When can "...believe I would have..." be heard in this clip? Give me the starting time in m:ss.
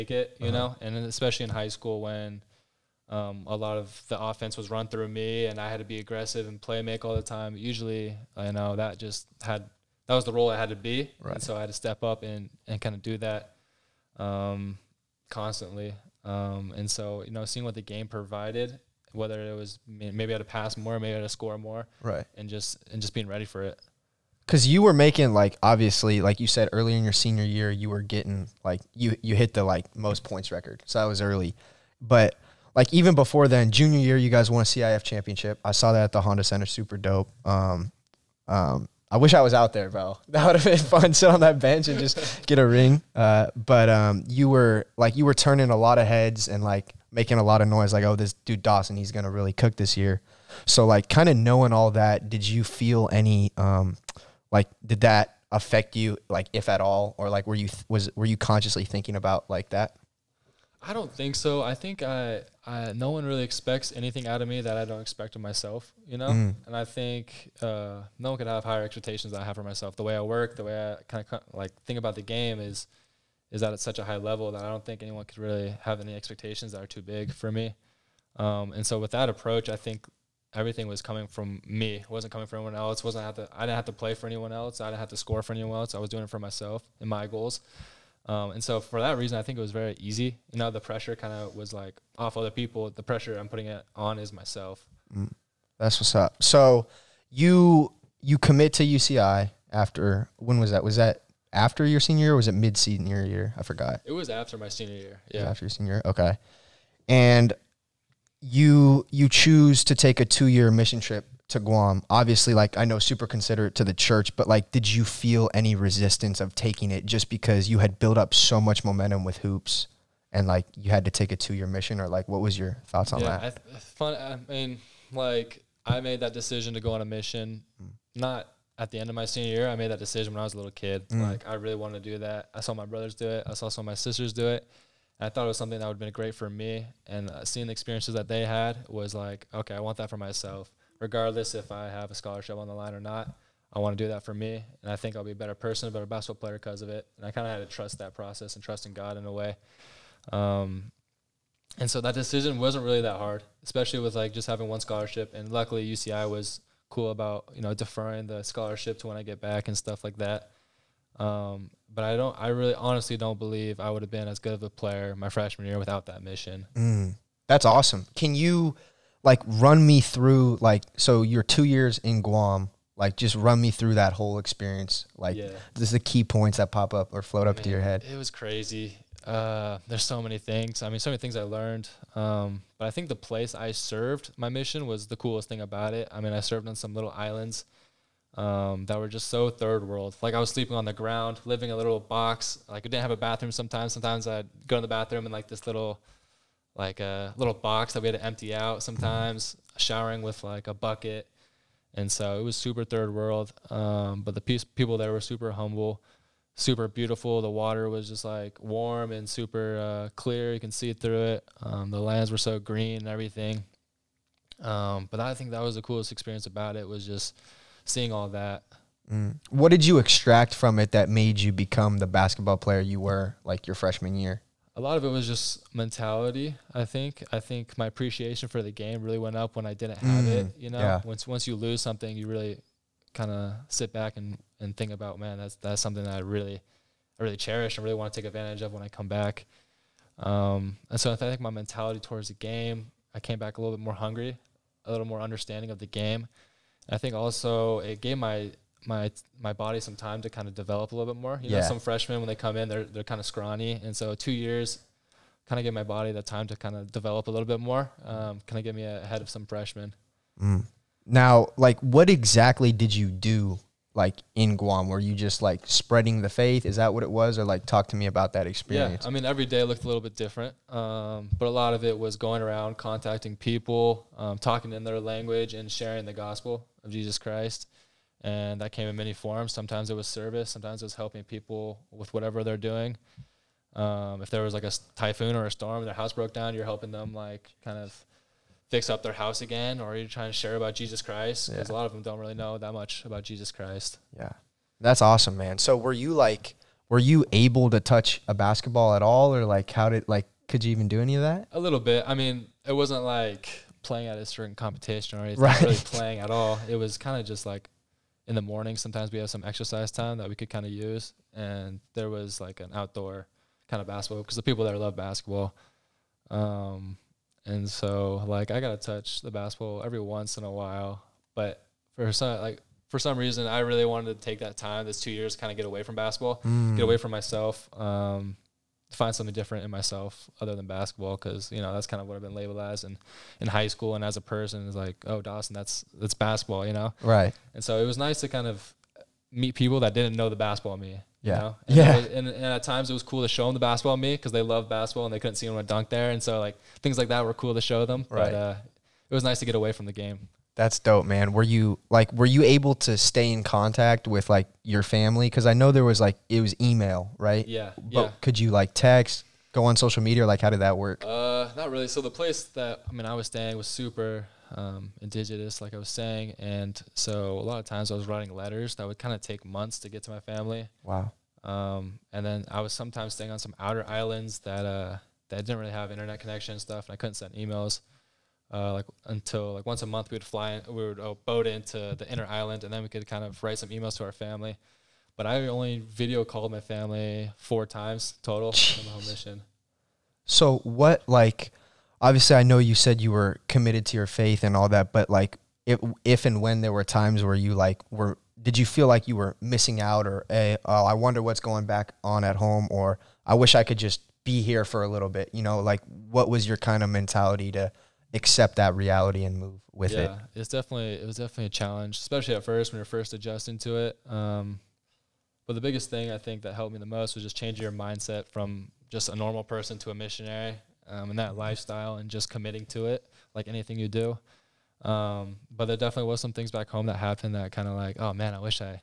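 2:43.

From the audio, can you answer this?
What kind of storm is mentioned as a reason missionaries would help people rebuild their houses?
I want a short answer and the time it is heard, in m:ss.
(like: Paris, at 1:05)
Typhoon, at 4:44.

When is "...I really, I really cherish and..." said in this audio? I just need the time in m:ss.
3:56.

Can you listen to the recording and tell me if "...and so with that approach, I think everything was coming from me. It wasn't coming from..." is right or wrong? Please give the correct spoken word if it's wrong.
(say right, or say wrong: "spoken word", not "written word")
right.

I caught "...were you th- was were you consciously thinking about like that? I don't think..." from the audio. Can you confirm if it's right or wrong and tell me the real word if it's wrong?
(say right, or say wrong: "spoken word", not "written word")
right.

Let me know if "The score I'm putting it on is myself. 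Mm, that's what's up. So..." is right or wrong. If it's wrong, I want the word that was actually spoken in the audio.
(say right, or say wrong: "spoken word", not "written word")
wrong: "pressure", not "score".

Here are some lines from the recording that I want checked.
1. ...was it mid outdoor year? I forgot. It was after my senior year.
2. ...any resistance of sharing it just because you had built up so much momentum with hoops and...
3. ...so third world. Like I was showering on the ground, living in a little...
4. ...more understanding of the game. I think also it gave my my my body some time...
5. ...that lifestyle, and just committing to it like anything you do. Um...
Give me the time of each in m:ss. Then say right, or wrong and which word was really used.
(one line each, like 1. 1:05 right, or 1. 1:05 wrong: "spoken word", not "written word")
1. 1:42 wrong: "senior", not "outdoor"
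2. 1:55 wrong: "taking", not "sharing"
3. 3:09 wrong: "sleeping", not "showering"
4. 4:05 right
5. 7:01 right.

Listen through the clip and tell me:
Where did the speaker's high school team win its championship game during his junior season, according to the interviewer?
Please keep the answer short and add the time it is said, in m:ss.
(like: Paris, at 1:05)
Honda Center, at 0:36.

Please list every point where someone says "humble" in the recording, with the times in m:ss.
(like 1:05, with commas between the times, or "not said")
3:25.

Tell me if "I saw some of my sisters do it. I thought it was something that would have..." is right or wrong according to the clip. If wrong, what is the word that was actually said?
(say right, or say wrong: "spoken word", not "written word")
right.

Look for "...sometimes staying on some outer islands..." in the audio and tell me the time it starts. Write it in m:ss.
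6:12.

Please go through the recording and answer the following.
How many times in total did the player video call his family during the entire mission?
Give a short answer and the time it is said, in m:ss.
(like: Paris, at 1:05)
4, at 6:27.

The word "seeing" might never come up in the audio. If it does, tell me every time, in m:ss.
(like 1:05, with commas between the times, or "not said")
0:17, 2:17, 3:37.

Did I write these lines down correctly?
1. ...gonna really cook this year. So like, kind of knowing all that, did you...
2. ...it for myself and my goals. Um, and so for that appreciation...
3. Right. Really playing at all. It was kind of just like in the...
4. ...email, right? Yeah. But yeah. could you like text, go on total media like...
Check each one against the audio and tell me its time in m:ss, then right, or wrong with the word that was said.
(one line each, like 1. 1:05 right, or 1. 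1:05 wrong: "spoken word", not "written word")
1. 0:49 right
2. 1:26 wrong: "reason", not "appreciation"
3. 5:05 right
4. 5:56 wrong: "social", not "total".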